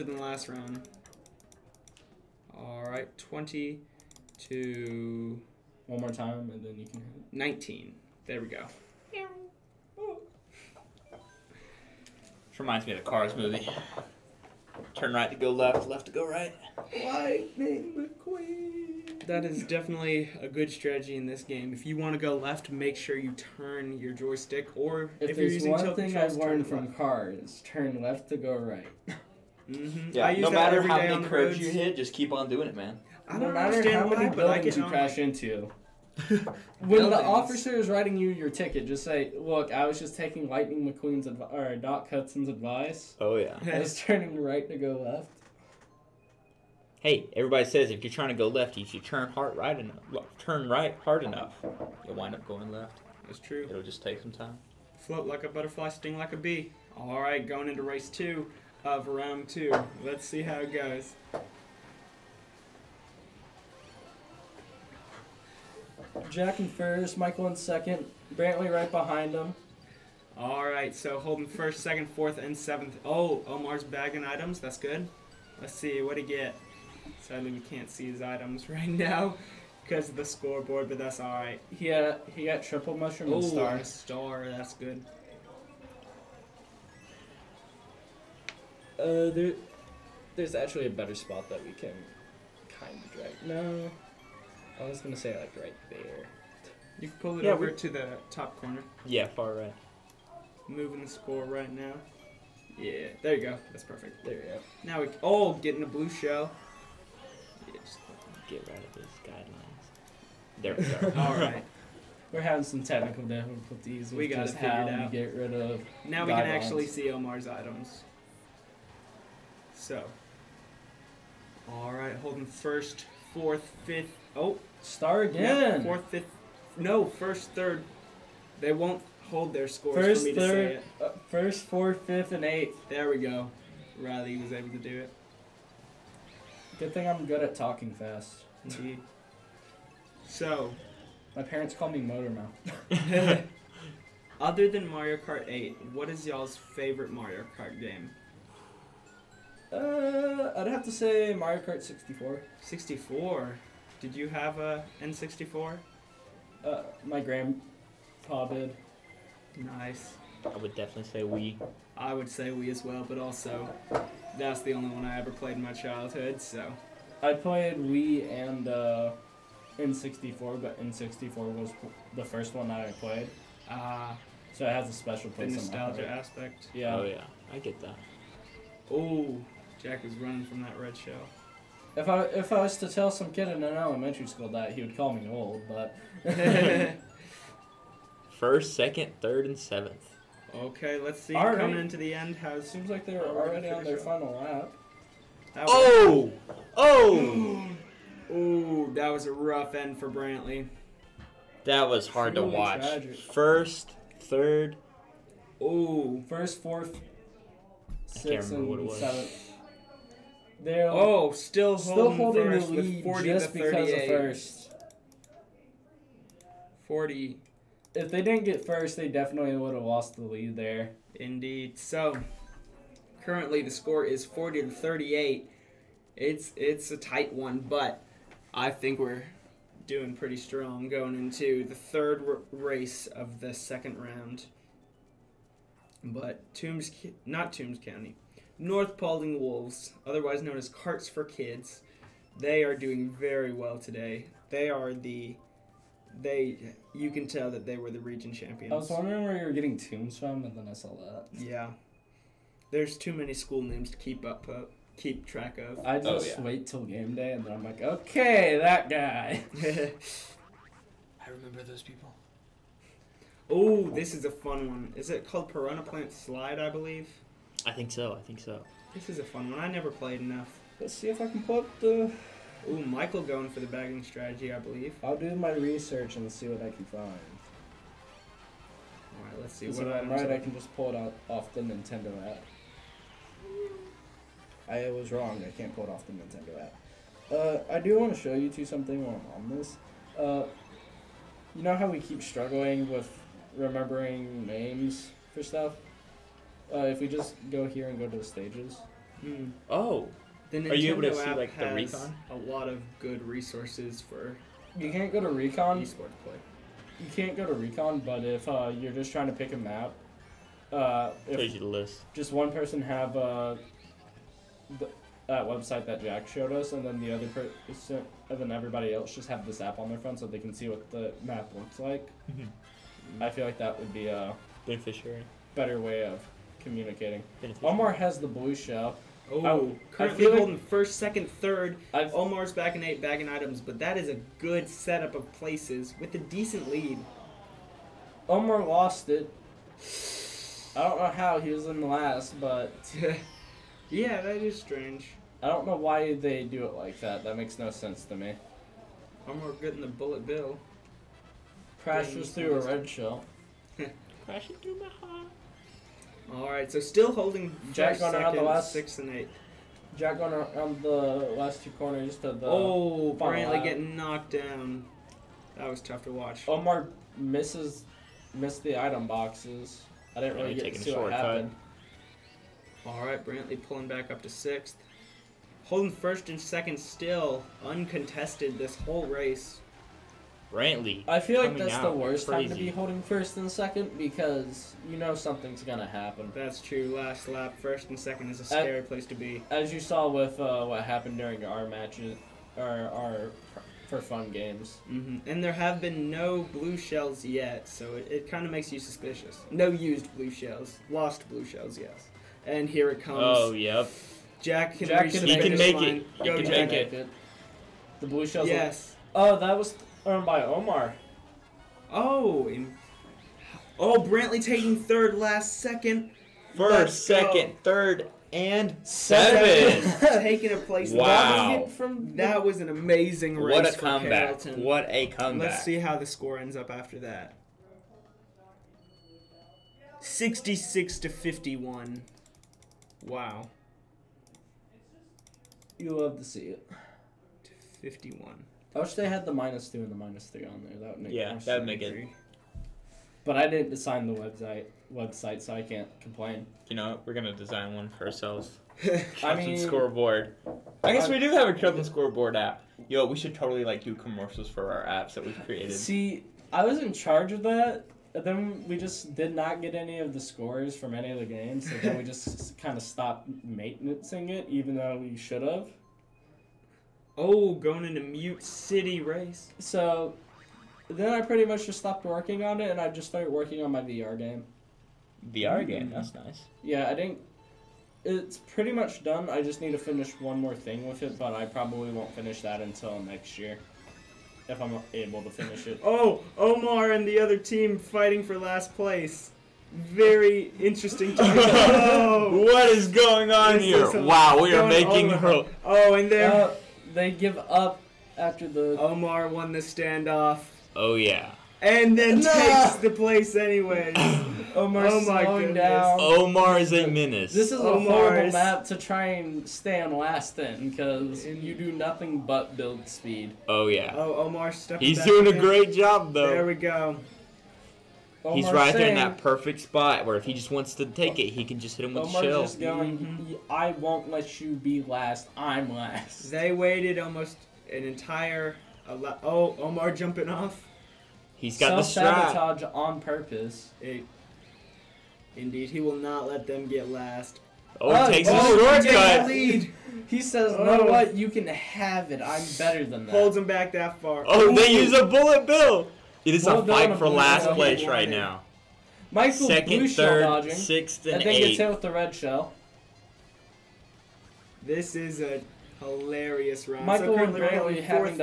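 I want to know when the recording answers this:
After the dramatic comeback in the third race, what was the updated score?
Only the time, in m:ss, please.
7:09.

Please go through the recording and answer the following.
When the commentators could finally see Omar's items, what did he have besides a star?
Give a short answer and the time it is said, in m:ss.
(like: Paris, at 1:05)
Triple mushroom, at 1:22.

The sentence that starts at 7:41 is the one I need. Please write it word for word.
So then we just kind of stopped maintaining it, even though we should have.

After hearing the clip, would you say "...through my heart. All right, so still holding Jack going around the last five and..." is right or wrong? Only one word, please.
wrong.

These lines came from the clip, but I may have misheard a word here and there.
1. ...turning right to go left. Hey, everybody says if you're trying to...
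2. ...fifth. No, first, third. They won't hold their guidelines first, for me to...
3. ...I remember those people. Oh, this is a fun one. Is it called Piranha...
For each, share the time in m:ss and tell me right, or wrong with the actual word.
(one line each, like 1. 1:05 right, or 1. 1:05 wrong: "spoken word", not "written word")
1. 0:43 right
2. 2:06 wrong: "scores", not "guidelines"
3. 4:21 right.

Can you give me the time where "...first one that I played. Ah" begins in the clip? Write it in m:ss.
2:52.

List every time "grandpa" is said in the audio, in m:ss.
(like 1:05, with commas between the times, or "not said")
2:37.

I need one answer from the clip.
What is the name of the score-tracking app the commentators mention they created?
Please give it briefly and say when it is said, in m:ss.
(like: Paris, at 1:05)
Captain Scoreboard, at 7:31.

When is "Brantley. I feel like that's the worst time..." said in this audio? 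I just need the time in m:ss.
6:20.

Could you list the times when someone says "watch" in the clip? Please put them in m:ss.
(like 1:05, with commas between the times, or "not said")
3:22, 6:06.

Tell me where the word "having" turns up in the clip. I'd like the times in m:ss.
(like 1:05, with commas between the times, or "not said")
1:52.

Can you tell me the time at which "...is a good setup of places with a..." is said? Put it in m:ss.
5:33.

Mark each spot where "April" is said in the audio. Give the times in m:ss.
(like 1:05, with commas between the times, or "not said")
not said.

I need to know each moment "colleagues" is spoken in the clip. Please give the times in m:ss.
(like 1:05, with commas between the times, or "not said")
not said.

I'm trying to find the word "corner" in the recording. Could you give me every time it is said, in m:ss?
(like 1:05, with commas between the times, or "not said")
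1:38, 6:01.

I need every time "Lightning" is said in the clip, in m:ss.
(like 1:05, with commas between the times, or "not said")
0:17, 0:40.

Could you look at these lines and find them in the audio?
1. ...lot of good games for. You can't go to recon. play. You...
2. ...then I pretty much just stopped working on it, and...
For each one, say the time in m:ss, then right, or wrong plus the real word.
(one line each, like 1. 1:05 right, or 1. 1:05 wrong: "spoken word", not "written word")
1. 5:02 wrong: "resources", not "games"
2. 7:50 right.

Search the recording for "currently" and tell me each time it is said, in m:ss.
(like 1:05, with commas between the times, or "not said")
3:43, 5:29.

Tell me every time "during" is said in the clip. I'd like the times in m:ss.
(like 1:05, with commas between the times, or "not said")
6:31.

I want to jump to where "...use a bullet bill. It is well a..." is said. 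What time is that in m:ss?
9:04.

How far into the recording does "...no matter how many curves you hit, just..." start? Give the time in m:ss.
0:30.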